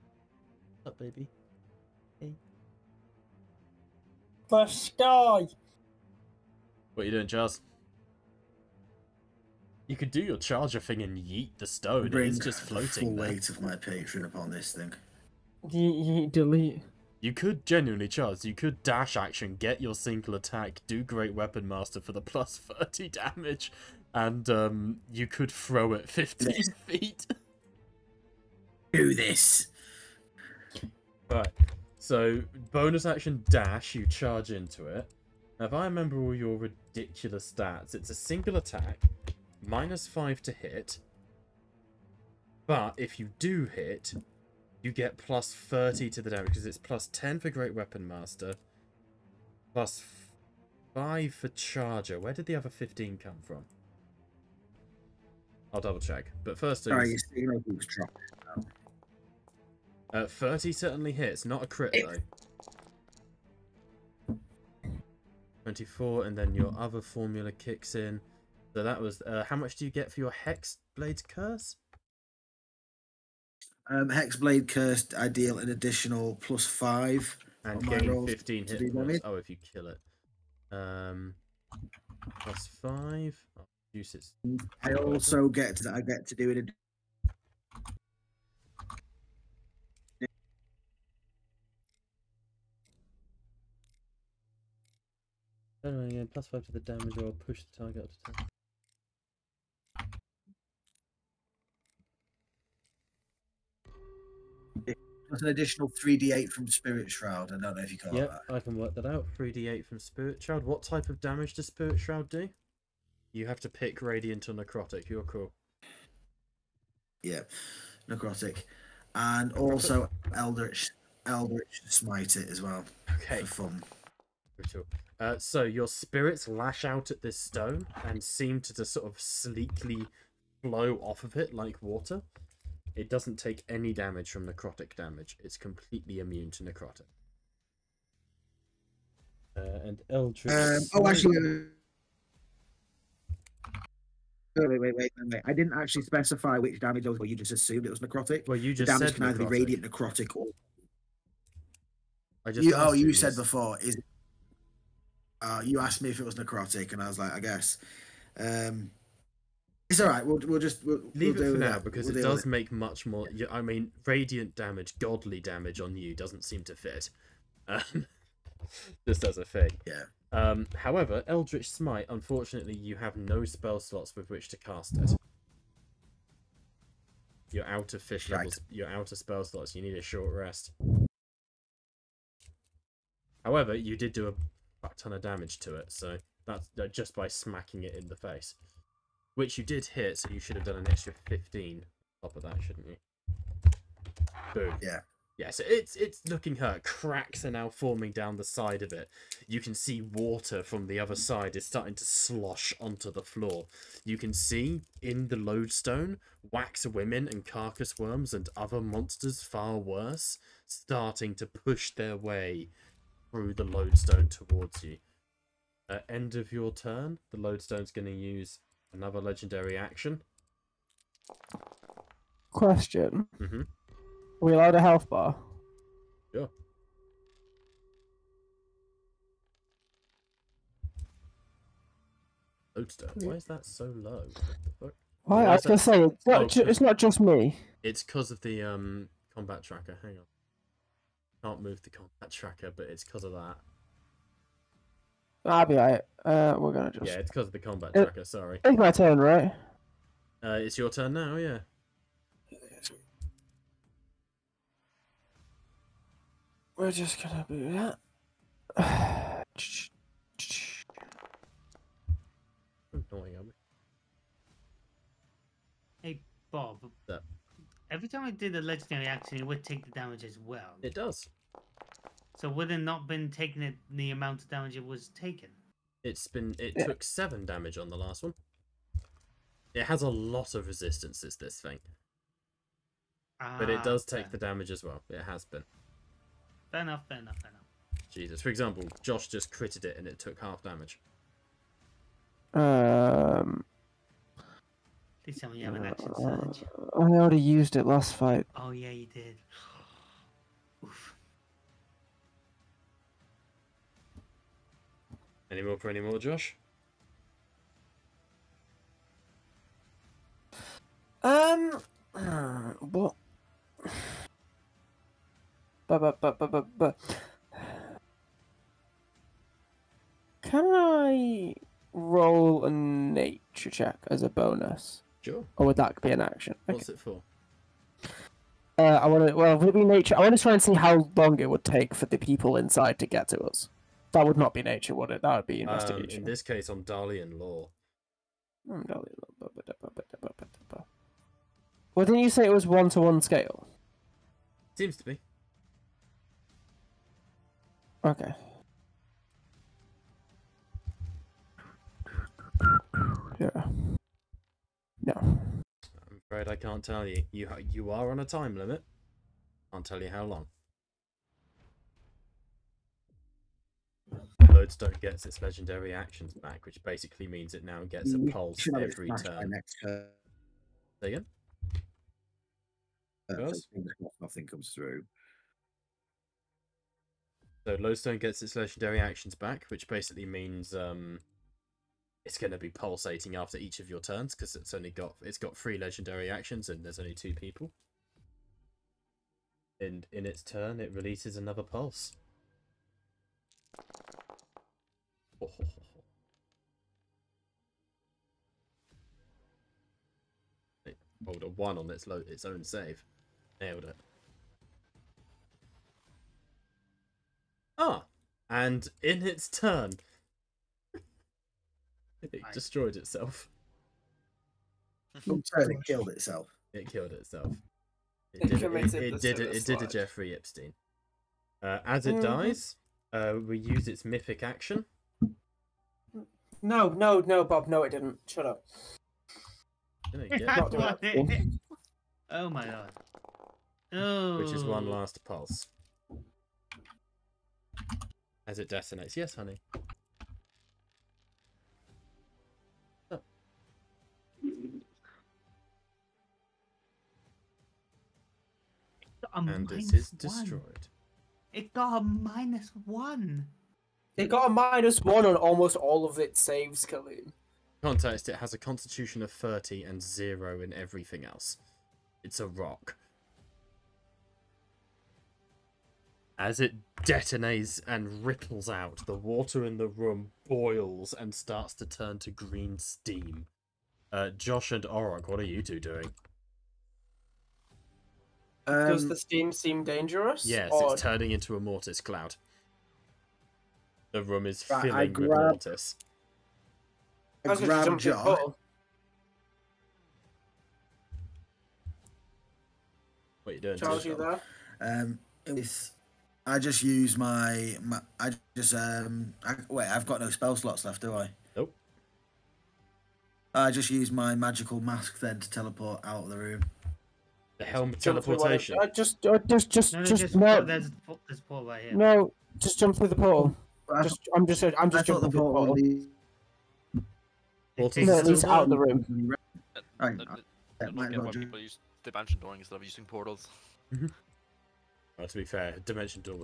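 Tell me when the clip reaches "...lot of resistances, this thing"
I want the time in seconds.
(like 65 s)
280 s.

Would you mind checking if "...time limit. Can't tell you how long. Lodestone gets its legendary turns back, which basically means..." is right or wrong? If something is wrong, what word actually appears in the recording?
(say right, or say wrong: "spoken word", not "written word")
wrong: "actions", not "turns".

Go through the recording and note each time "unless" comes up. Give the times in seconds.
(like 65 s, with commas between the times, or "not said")
not said.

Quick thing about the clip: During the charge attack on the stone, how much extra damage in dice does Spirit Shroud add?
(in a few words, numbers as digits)
3d8.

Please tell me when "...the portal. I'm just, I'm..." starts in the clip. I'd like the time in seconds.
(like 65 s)
513 s.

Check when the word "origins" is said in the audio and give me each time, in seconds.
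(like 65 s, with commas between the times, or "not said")
not said.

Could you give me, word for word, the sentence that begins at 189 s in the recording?
Which you did hit, so you should have done an extra 15 on top of that, shouldn't you?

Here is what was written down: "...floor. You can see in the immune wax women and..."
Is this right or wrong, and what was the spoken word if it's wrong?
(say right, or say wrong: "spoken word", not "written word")
wrong: "lodestone", not "immune".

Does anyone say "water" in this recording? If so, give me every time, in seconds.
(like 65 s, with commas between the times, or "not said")
131 s, 199 s, 469 s.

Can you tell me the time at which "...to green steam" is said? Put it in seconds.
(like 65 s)
472 s.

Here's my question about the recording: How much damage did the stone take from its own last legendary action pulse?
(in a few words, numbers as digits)
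7.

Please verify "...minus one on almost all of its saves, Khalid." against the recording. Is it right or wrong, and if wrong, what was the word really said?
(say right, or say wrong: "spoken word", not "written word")
right.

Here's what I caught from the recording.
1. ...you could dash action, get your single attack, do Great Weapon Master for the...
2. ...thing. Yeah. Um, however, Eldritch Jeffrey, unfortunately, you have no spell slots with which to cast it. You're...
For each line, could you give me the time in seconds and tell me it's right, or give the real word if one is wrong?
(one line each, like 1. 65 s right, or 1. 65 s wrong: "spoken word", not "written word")
1. 18 s right
2. 169 s wrong: "Smite", not "Jeffrey".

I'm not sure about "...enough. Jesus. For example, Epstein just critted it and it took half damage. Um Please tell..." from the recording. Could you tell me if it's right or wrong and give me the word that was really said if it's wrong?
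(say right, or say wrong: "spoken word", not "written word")
wrong: "Josh", not "Epstein".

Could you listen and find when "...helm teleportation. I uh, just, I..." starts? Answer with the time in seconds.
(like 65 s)
507 s.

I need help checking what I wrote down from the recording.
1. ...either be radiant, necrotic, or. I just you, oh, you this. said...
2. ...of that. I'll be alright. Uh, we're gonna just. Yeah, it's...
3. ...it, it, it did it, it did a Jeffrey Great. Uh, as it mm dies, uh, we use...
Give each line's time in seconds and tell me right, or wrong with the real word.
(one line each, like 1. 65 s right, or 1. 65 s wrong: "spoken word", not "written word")
1. 149 s right
2. 243 s right
3. 418 s wrong: "Epstein", not "Great".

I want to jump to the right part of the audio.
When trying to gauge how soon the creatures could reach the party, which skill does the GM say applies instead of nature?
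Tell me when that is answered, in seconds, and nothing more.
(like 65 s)
335 s.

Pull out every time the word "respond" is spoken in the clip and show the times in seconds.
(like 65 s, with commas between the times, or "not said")
not said.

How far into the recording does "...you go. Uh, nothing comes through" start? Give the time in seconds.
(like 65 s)
371 s.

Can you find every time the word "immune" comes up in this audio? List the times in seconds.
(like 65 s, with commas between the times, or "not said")
136 s.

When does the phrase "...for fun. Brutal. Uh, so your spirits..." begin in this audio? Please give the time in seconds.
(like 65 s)
123 s.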